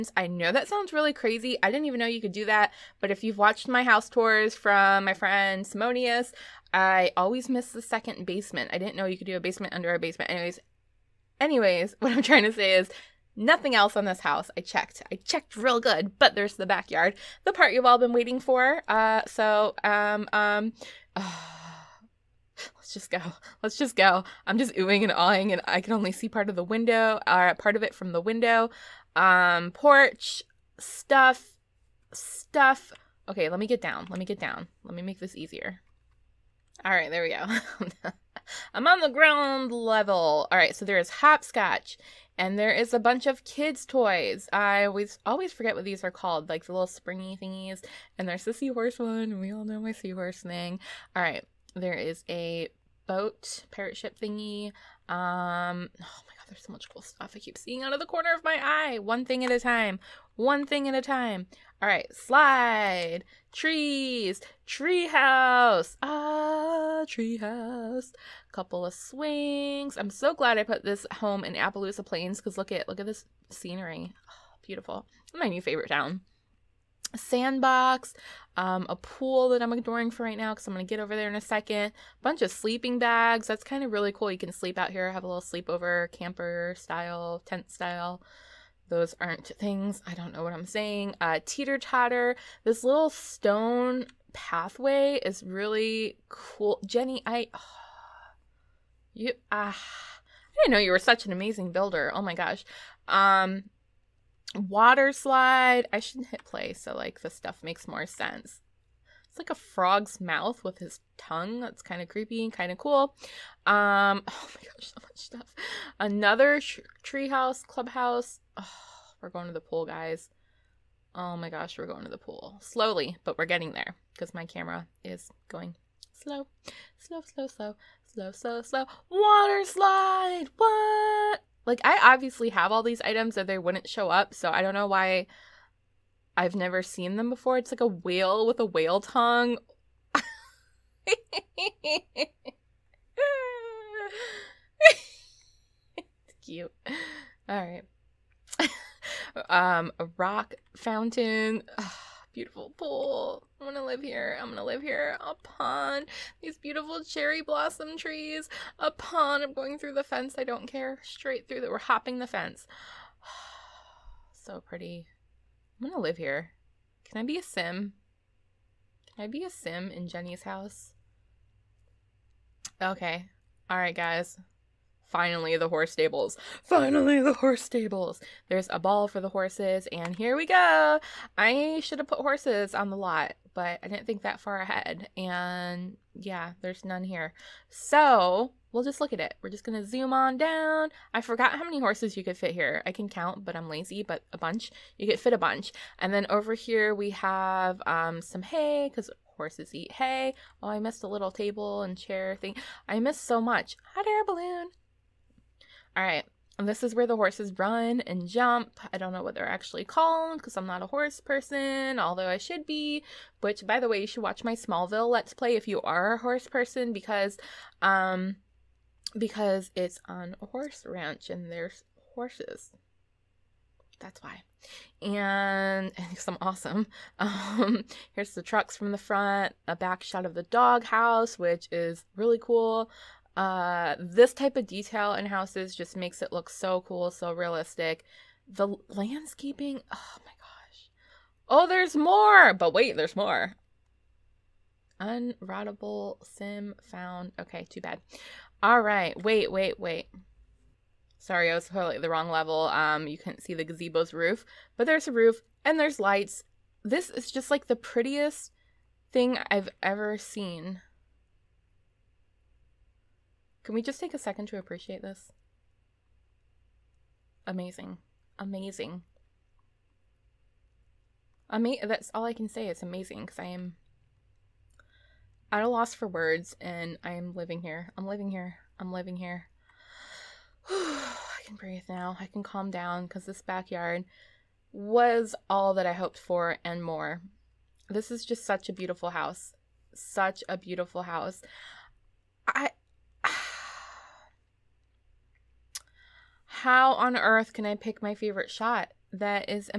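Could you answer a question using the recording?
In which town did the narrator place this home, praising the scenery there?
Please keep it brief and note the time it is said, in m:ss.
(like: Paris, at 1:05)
Appaloosa Plains, at 1:11.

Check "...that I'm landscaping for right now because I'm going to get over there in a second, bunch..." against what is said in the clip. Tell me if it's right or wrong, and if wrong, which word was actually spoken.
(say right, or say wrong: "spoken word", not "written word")
wrong: "ignoring", not "landscaping".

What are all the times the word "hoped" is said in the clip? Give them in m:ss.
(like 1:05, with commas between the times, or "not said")
4:45.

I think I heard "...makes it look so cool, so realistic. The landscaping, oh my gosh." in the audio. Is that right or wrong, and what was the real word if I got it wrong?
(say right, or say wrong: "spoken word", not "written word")
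right.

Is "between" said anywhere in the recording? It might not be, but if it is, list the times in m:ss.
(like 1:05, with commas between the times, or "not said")
not said.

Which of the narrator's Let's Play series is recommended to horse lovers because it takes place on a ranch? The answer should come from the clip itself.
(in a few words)
Smallville.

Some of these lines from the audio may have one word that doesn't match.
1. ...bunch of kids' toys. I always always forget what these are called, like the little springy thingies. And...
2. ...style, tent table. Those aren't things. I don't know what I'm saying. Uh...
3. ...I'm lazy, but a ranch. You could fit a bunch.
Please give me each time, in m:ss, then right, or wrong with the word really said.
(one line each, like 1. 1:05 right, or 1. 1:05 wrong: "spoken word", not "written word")
1. 0:42 right
2. 1:26 wrong: "style", not "table"
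3. 3:13 wrong: "bunch", not "ranch".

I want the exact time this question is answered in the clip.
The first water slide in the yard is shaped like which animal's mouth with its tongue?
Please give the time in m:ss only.
1:49.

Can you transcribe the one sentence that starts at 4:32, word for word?
It's amazing because I am at a loss for words and I am living here.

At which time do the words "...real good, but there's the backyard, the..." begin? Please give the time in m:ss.
0:15.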